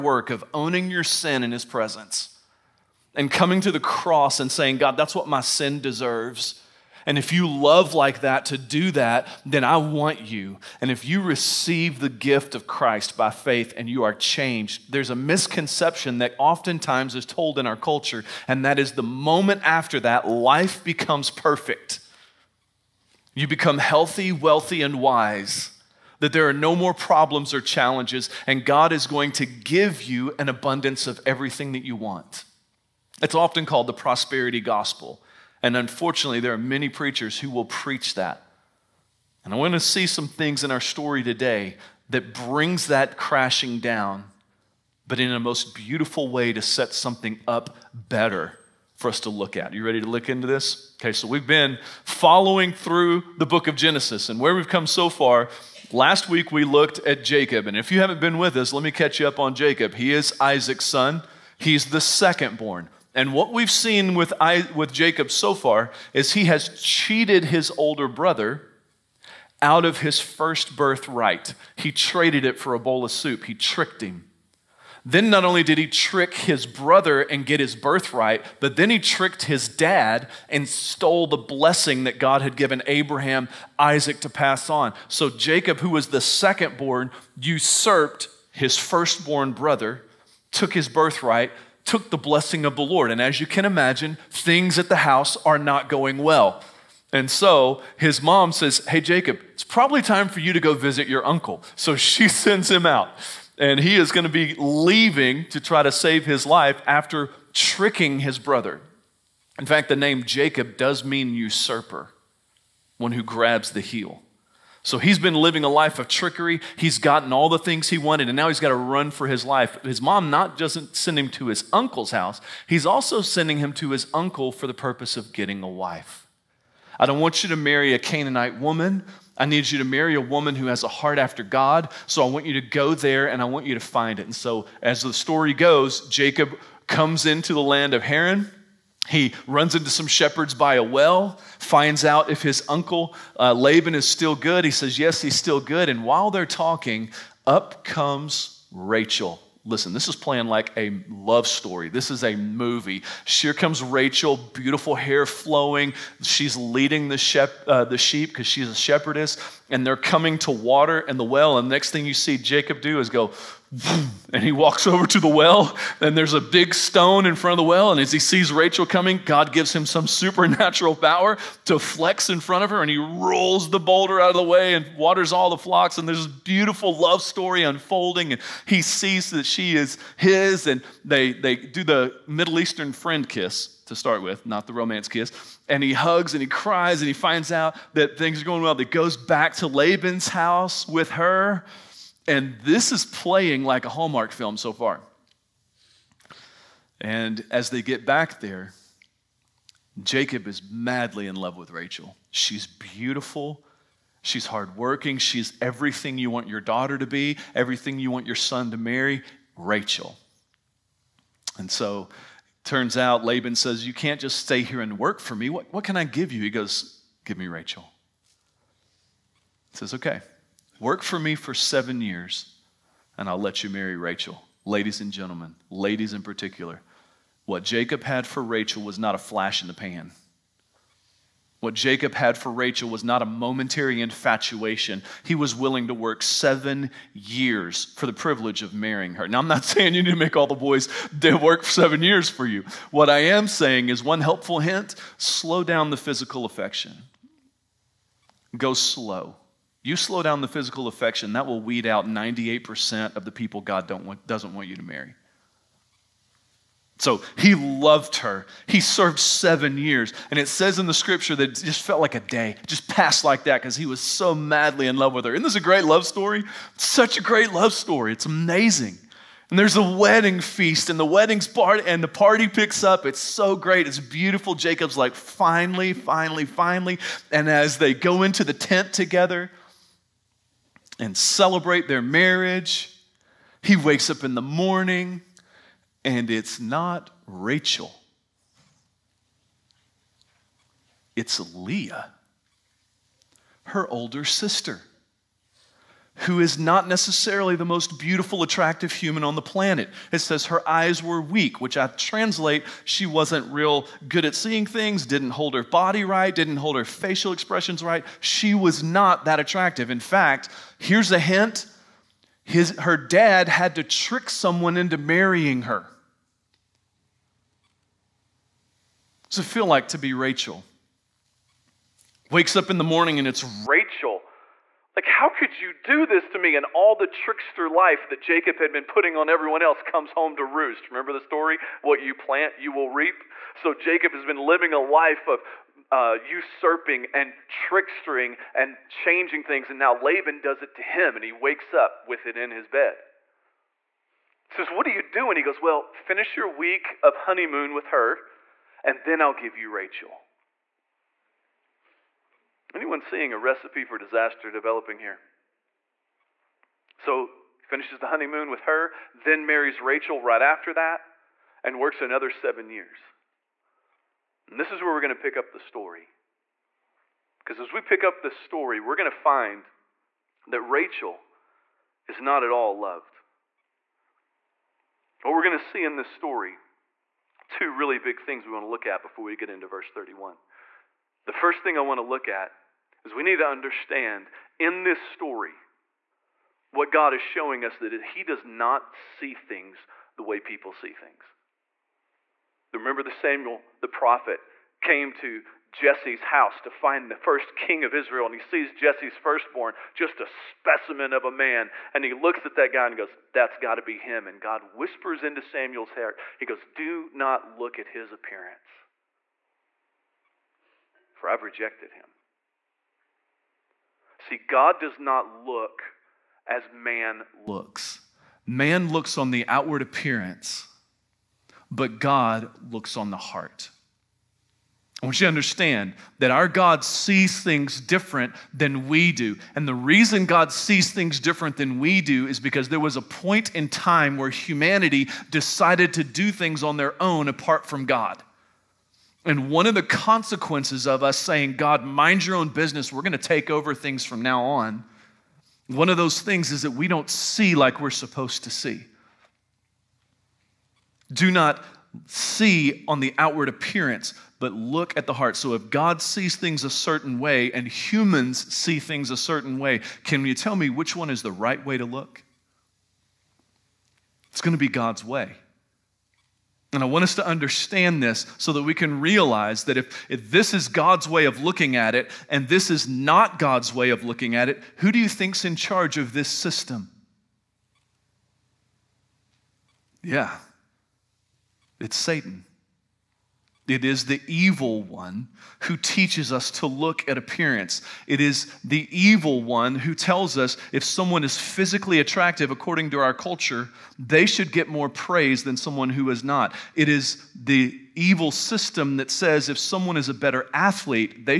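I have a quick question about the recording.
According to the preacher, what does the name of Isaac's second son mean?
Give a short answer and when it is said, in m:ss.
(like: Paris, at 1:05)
Usurper, at 1:51.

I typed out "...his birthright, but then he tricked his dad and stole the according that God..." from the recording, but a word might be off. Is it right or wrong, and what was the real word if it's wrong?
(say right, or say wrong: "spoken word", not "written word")
wrong: "blessing", not "according".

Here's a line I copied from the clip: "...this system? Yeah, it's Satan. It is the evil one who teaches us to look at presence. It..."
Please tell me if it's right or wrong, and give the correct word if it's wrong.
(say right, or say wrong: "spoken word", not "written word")
wrong: "appearance", not "presence".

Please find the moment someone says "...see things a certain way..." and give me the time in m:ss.
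7:38.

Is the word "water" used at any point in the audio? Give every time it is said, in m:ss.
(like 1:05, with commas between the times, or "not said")
2:40, 2:54.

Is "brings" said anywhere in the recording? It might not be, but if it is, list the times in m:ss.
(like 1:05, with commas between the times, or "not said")
0:42.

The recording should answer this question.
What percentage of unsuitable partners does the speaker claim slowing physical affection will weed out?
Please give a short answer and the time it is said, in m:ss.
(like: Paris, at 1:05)
98%, at 4:12.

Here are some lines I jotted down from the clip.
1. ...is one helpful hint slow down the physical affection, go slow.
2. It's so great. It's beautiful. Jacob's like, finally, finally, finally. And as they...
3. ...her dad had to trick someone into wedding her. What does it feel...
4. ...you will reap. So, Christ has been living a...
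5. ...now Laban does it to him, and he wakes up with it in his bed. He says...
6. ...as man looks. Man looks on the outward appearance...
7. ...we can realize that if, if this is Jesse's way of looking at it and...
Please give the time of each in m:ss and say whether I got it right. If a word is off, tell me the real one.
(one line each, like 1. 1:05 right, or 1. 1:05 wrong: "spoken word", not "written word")
1. 4:03 right
2. 4:33 right
3. 5:12 wrong: "marrying", not "wedding"
4. 5:32 wrong: "Jacob", not "Christ"
5. 5:39 right
6. 6:56 right
7. 7:48 wrong: "God", not "Jesse".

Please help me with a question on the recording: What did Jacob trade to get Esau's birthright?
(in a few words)
A bowl of soup.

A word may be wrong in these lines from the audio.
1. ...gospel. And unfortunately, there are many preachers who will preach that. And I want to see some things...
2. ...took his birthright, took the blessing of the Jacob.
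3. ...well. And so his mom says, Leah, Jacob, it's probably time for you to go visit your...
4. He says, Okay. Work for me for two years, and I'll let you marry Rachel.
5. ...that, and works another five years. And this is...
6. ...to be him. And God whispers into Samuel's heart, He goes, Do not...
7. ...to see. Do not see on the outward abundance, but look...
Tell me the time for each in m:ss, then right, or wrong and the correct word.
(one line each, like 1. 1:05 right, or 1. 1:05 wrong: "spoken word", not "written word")
1. 0:34 right
2. 1:30 wrong: "Lord", not "Jacob"
3. 1:36 wrong: "Hey", not "Leah"
4. 3:39 wrong: "seven", not "two"
5. 6:00 wrong: "seven", not "five"
6. 6:43 right
7. 7:28 wrong: "appearance", not "abundance".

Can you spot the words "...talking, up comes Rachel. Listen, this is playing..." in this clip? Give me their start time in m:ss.
2:26.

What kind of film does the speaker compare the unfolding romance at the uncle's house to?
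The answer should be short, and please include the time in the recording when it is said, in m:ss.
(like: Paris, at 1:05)
A Hallmark film, at 3:13.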